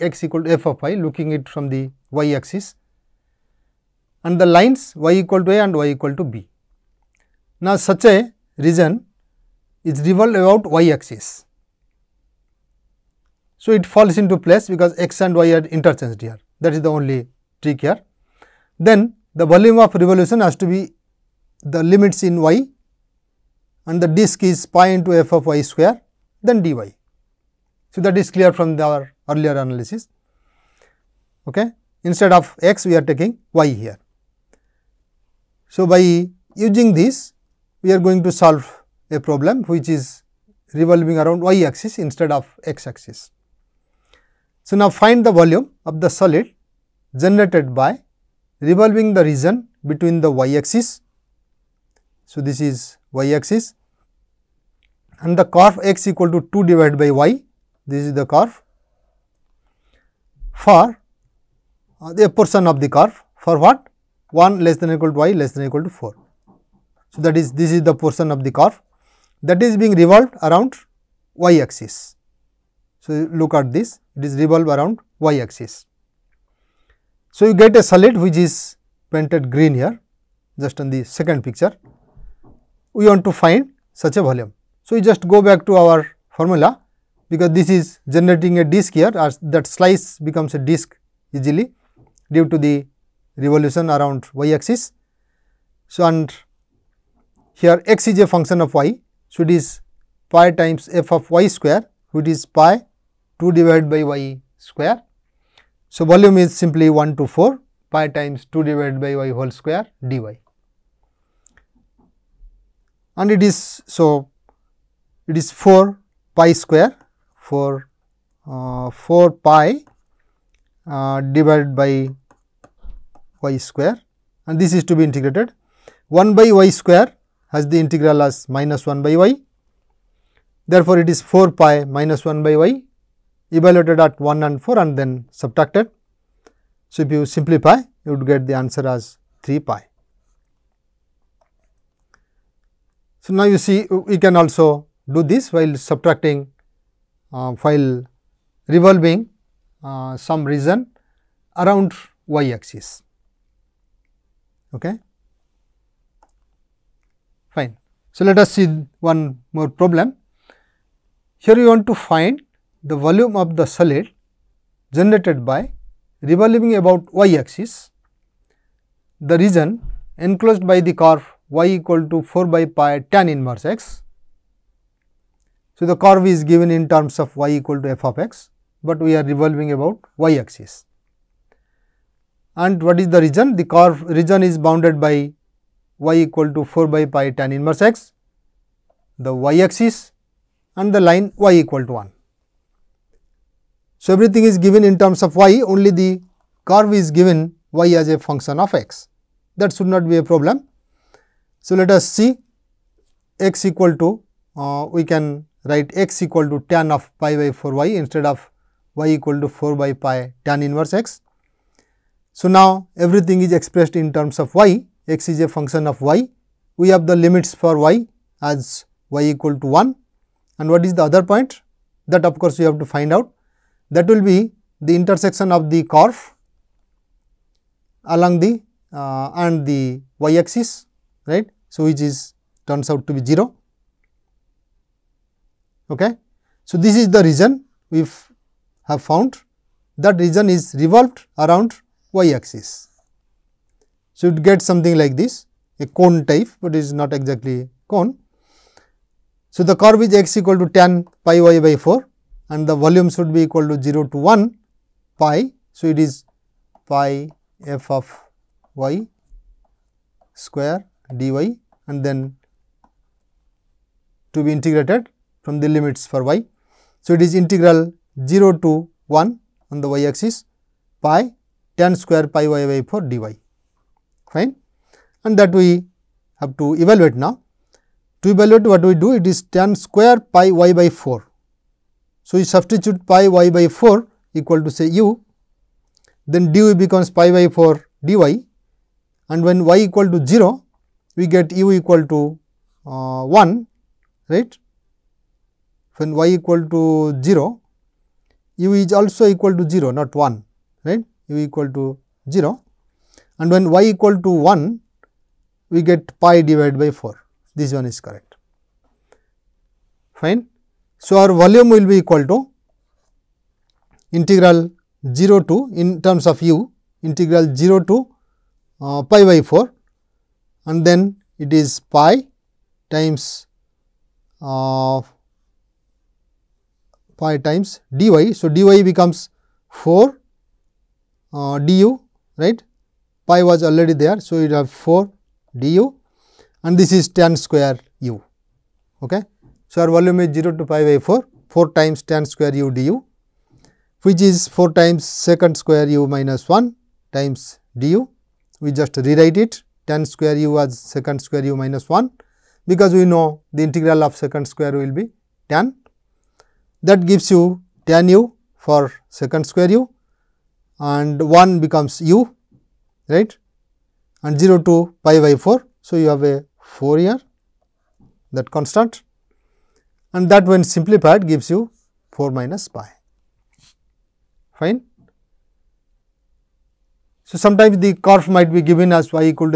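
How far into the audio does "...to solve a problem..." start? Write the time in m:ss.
0:38.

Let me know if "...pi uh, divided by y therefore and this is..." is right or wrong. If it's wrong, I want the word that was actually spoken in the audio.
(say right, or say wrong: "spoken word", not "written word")
wrong: "square", not "therefore".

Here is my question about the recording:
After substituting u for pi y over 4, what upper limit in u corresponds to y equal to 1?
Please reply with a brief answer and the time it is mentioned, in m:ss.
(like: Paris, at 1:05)
pi/4, at 5:06.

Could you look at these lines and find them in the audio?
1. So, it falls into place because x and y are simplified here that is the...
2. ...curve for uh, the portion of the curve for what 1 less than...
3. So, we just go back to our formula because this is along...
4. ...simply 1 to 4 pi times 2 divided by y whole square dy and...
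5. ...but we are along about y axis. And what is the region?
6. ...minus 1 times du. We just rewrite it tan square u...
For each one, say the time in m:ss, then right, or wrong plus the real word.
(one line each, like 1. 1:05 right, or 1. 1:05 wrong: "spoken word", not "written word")
1. 0:13 wrong: "interchanged", not "simplified"
2. 0:58 right
3. 1:24 wrong: "generating", not "along"
4. 1:46 right
5. 2:58 wrong: "revolving", not "along"
6. 5:46 right.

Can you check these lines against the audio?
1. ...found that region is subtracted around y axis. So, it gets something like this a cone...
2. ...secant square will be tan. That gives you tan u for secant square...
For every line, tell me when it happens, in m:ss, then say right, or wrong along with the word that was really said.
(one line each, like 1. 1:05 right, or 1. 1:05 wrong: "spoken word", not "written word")
1. 3:59 wrong: "revolved", not "subtracted"
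2. 5:54 right.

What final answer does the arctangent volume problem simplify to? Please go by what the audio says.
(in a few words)
4 minus pi.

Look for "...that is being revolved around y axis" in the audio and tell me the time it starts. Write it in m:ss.
1:09.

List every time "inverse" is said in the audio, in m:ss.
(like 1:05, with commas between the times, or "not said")
2:53, 3:07, 3:30.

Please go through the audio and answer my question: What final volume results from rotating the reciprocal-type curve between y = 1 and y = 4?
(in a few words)
3 pi.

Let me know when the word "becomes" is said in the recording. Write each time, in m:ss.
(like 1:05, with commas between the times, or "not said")
1:30, 4:46, 5:28, 6:01.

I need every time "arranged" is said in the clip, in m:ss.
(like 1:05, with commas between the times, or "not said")
not said.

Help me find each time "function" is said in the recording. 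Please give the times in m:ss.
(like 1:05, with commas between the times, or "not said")
1:38, 3:18, 3:35.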